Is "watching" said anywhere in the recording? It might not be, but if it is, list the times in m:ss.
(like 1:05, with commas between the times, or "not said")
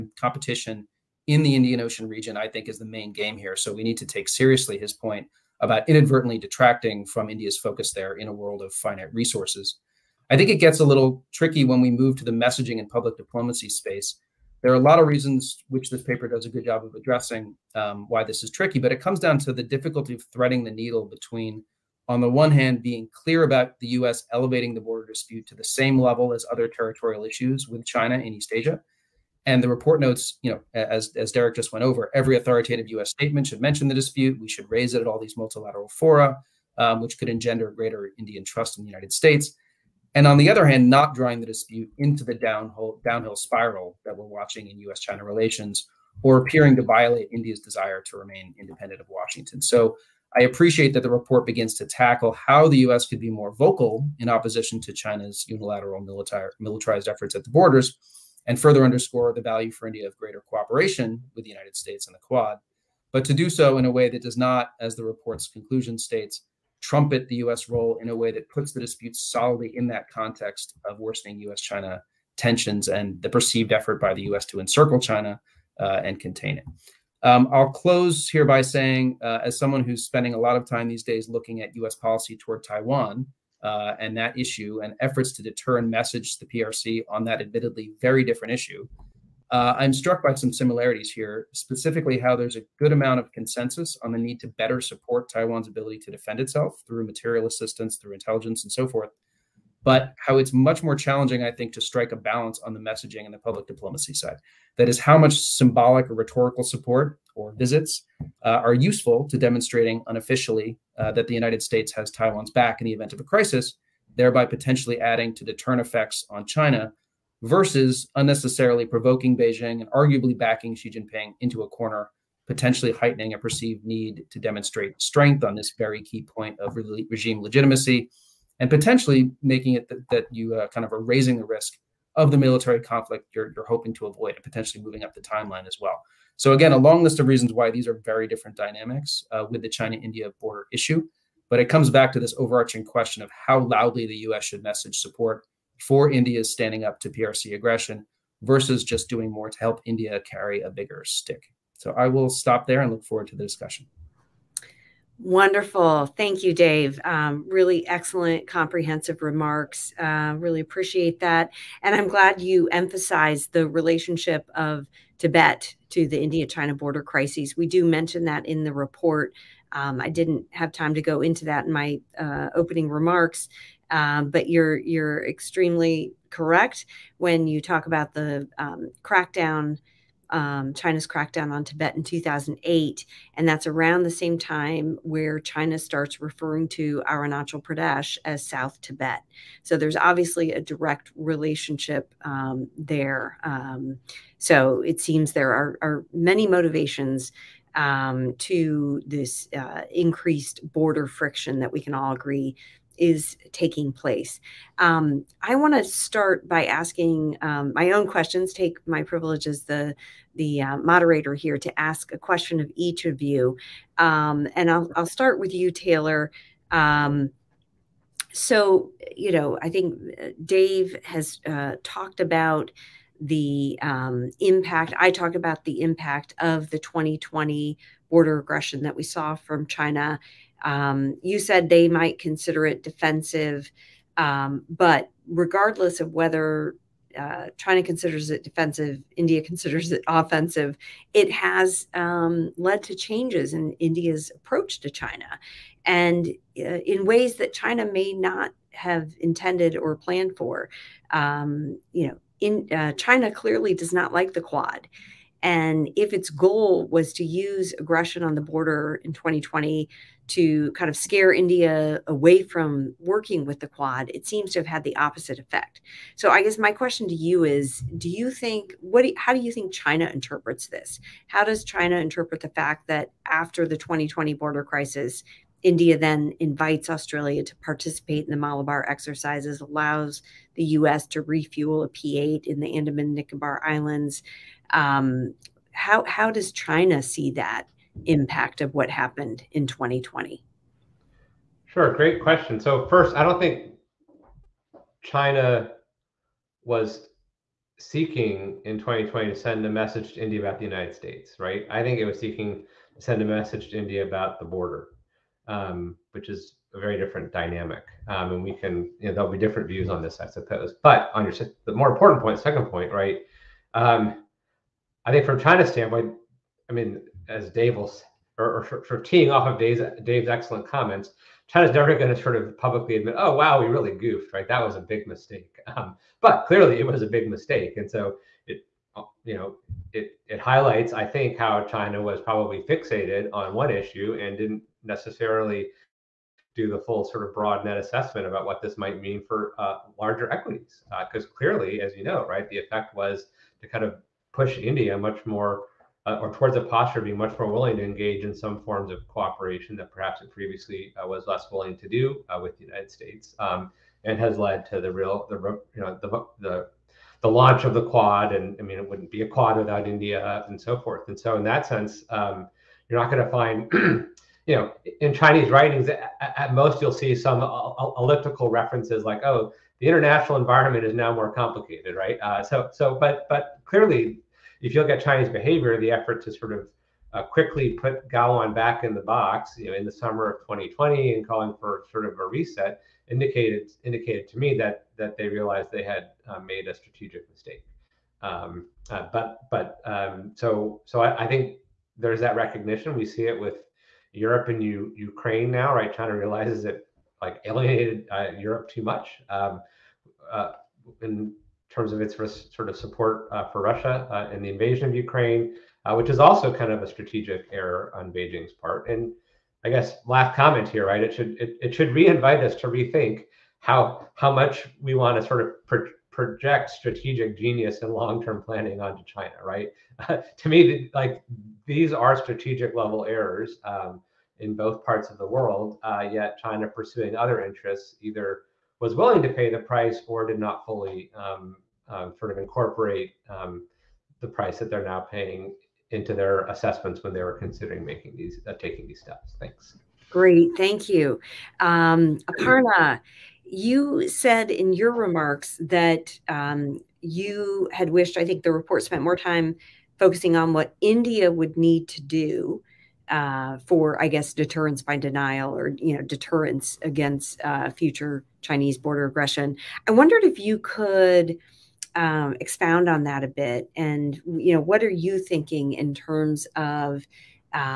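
0:44.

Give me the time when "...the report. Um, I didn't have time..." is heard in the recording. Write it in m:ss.
2:48.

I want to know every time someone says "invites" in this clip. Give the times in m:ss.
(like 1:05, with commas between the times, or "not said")
4:36, 6:51.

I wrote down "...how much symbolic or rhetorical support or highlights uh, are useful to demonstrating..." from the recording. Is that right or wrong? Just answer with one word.
wrong.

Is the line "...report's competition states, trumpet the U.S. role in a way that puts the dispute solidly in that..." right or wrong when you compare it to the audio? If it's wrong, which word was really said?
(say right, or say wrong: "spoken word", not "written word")
wrong: "conclusion", not "competition".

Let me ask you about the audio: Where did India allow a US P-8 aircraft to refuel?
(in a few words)
Andaman Nicobar Islands.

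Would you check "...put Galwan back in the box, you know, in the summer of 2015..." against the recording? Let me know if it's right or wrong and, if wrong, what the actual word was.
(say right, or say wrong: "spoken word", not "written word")
wrong: "2020", not "2015".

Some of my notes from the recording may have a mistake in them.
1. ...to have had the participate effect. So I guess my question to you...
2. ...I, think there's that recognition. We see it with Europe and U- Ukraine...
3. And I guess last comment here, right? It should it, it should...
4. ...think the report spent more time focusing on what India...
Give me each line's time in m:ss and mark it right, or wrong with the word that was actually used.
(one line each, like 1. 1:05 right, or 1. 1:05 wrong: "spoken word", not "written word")
1. 4:24 wrong: "opposite", not "participate"
2. 6:31 right
3. 6:48 right
4. 7:28 right.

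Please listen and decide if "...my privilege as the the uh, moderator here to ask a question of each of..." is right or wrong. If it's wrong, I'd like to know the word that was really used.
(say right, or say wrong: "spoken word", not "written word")
right.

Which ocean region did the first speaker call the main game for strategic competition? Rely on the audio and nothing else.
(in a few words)
Indian Ocean.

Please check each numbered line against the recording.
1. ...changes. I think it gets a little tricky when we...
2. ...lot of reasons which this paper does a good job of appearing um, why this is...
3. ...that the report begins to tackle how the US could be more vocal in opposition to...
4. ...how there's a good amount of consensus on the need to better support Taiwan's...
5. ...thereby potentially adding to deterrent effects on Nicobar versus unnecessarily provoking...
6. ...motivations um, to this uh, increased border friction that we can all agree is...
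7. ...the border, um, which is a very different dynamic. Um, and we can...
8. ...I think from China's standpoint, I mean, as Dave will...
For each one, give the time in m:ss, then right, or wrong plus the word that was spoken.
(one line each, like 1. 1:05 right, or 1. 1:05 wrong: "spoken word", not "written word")
1. 0:09 wrong: "resources", not "changes"
2. 0:14 wrong: "addressing", not "appearing"
3. 0:50 right
4. 1:32 right
5. 1:54 wrong: "China", not "Nicobar"
6. 3:16 right
7. 5:04 right
8. 5:15 right.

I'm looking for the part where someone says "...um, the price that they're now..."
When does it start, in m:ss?
7:13.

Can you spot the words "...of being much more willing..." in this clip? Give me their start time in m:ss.
5:46.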